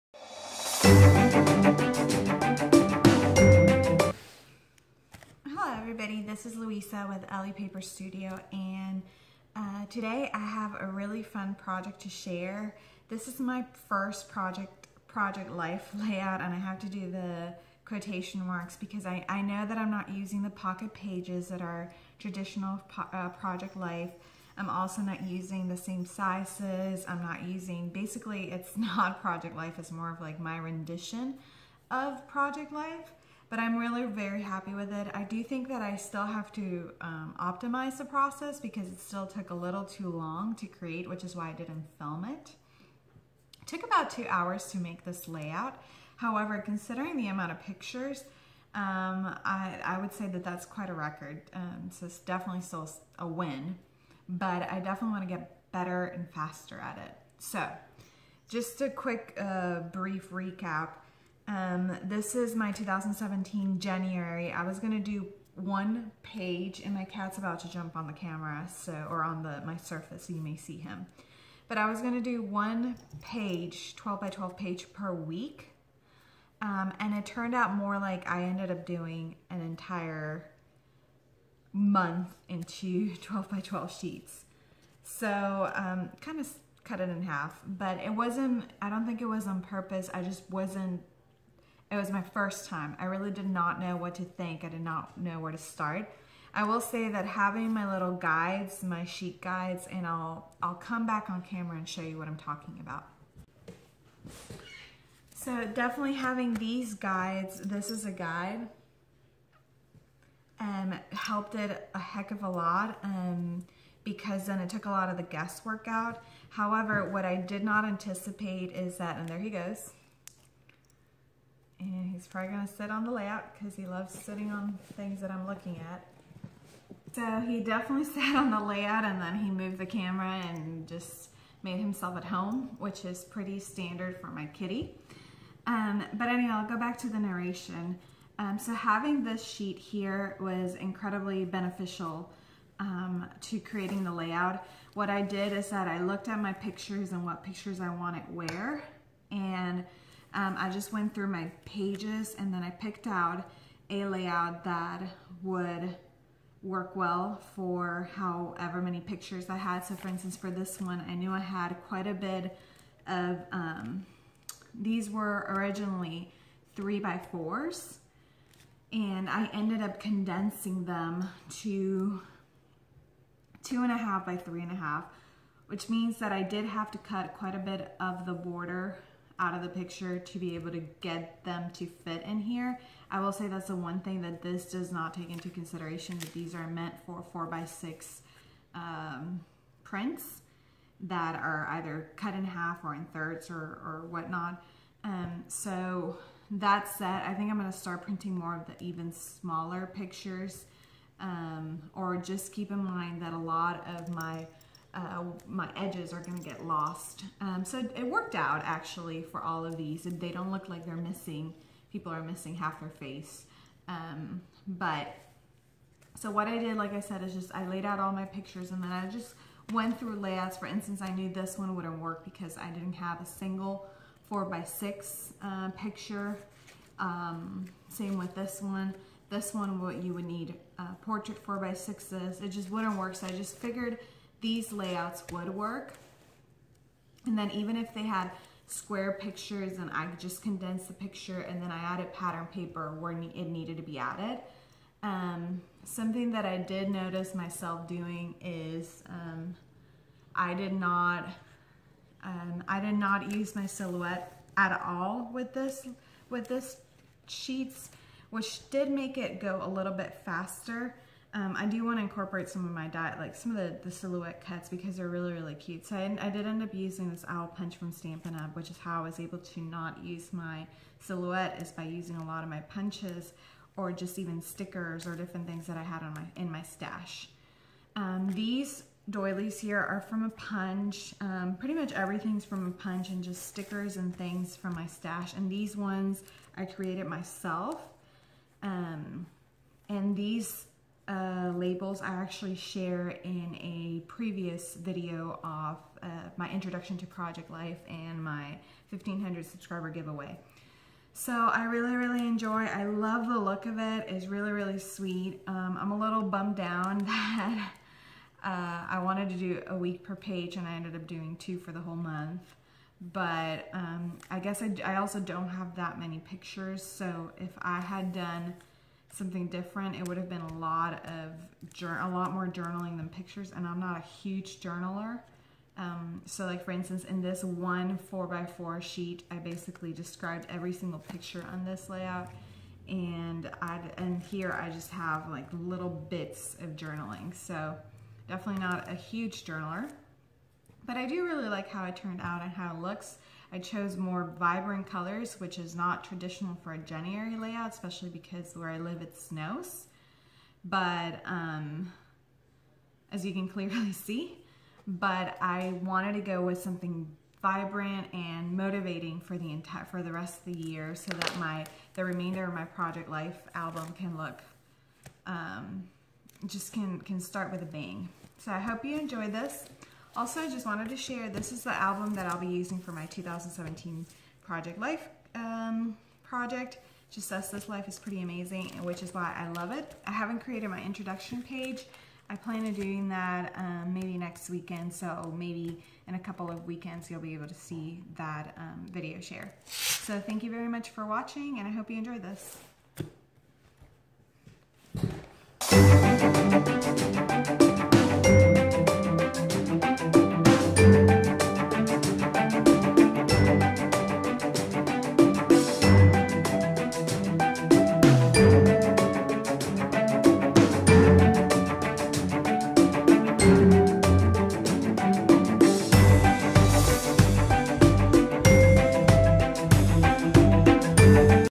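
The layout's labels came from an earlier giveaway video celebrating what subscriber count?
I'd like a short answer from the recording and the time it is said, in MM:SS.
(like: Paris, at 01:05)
1500, at 04:58.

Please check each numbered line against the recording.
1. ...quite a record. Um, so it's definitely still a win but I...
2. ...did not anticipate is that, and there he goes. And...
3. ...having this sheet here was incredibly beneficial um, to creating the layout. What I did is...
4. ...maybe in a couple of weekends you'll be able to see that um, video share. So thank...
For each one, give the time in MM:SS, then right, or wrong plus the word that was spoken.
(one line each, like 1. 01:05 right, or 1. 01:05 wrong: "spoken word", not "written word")
1. 00:50 right
2. 01:57 right
3. 02:18 right
4. 06:25 right.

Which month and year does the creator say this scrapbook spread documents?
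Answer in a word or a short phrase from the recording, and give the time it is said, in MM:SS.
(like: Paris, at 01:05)
2017 January, at 01:02.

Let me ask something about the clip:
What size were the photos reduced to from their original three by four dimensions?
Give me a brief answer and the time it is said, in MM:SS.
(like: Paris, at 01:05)
2.5 by 3.5, at 02:53.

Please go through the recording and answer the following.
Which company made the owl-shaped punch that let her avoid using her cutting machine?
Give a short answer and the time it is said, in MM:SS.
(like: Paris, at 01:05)
Stampin' Up, at 04:27.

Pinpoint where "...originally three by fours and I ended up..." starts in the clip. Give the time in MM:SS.
02:45.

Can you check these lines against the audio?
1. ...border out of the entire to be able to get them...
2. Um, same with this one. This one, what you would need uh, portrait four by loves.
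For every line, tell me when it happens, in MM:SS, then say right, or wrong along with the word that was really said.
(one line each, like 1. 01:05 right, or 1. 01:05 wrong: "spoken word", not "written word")
1. 02:58 wrong: "picture", not "entire"
2. 03:46 wrong: "sixes", not "loves".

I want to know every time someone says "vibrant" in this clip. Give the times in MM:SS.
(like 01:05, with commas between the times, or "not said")
05:44, 05:57.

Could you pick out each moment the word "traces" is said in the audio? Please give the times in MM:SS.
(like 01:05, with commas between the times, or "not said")
not said.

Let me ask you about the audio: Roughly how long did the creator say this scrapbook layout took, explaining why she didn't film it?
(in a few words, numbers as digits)
2 hours.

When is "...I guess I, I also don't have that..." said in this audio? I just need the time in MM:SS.
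05:14.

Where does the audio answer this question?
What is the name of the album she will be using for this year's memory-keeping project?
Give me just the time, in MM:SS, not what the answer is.
06:17.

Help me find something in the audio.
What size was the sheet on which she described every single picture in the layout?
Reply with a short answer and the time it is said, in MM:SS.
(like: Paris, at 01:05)
4 by 4, at 05:27.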